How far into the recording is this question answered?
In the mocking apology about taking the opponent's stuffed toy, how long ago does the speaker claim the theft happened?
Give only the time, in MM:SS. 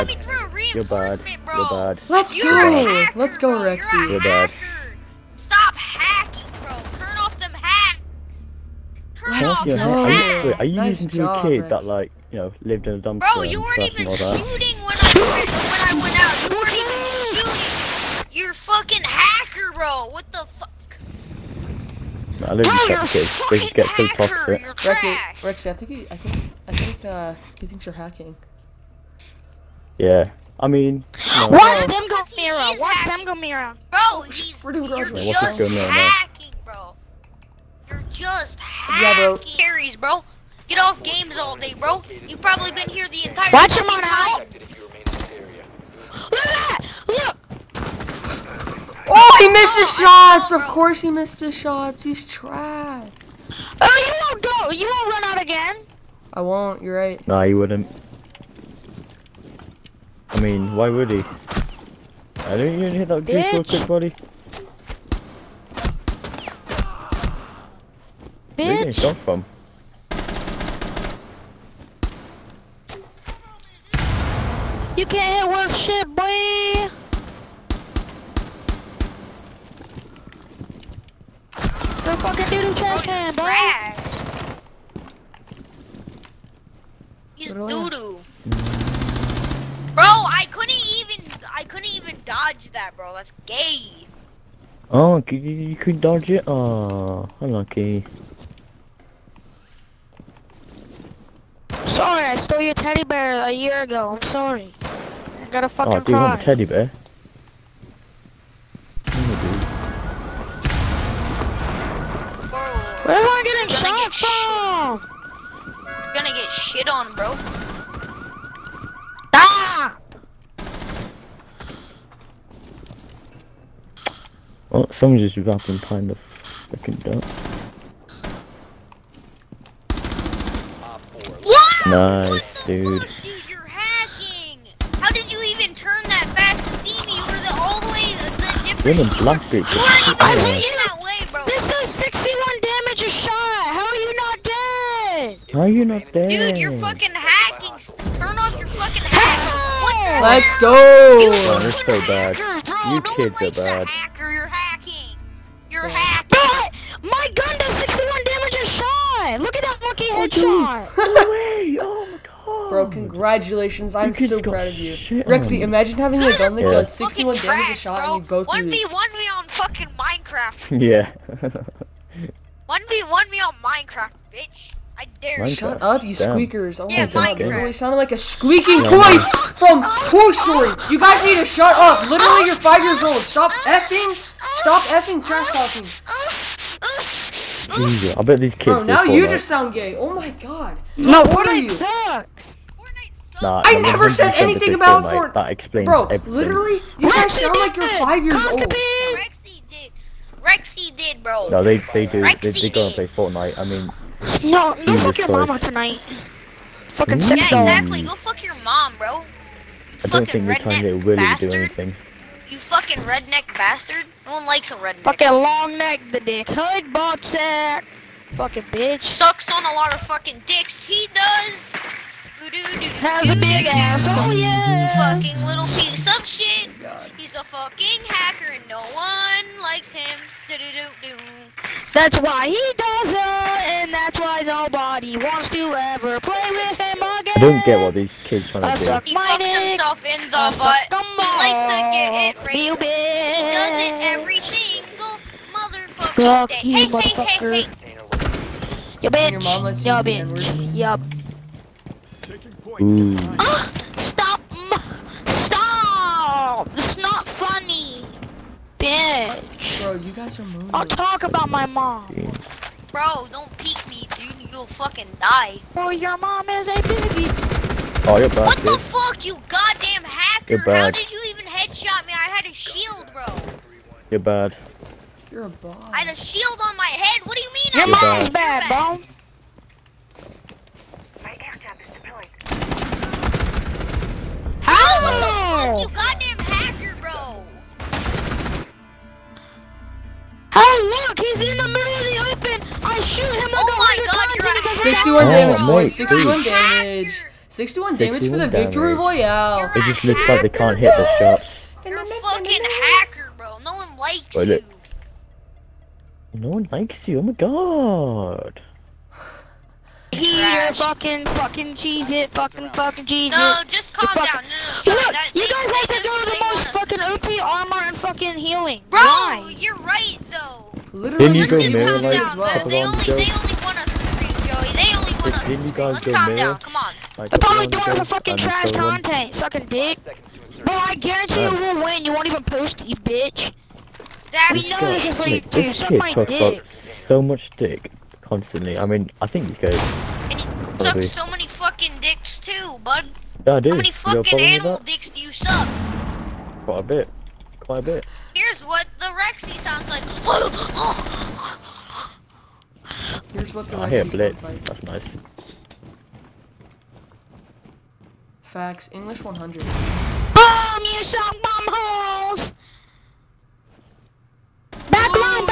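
01:43.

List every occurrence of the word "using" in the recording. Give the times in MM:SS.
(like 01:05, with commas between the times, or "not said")
00:11.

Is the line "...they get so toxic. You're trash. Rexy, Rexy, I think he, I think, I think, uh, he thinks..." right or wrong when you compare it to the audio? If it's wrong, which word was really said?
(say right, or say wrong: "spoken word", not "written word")
right.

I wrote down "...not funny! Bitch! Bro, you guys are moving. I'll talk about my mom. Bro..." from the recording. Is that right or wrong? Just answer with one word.
right.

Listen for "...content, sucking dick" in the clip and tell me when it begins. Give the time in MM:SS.
05:28.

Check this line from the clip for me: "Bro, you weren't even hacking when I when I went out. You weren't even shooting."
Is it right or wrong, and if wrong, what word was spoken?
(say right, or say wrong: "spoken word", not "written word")
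wrong: "shooting", not "hacking".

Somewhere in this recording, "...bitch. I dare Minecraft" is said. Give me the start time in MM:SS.
02:54.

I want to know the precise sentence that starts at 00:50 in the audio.
Of course, he missed his shots.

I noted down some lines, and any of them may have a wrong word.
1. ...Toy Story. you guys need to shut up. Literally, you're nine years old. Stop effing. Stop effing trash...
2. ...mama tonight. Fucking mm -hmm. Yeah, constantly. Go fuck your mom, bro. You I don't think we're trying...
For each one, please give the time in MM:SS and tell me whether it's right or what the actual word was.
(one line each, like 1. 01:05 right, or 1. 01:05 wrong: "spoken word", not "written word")
1. 02:59 wrong: "five", not "nine"
2. 03:25 wrong: "exactly", not "constantly".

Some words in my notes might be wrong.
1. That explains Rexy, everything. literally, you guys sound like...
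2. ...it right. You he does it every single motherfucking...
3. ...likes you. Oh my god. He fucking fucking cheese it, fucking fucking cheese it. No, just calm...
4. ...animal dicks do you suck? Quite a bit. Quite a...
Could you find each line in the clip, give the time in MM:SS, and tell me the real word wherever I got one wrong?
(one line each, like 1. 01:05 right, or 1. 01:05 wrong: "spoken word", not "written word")
1. 03:15 wrong: "Bro", not "Rexy"
2. 04:02 right
3. 05:06 right
4. 05:44 right.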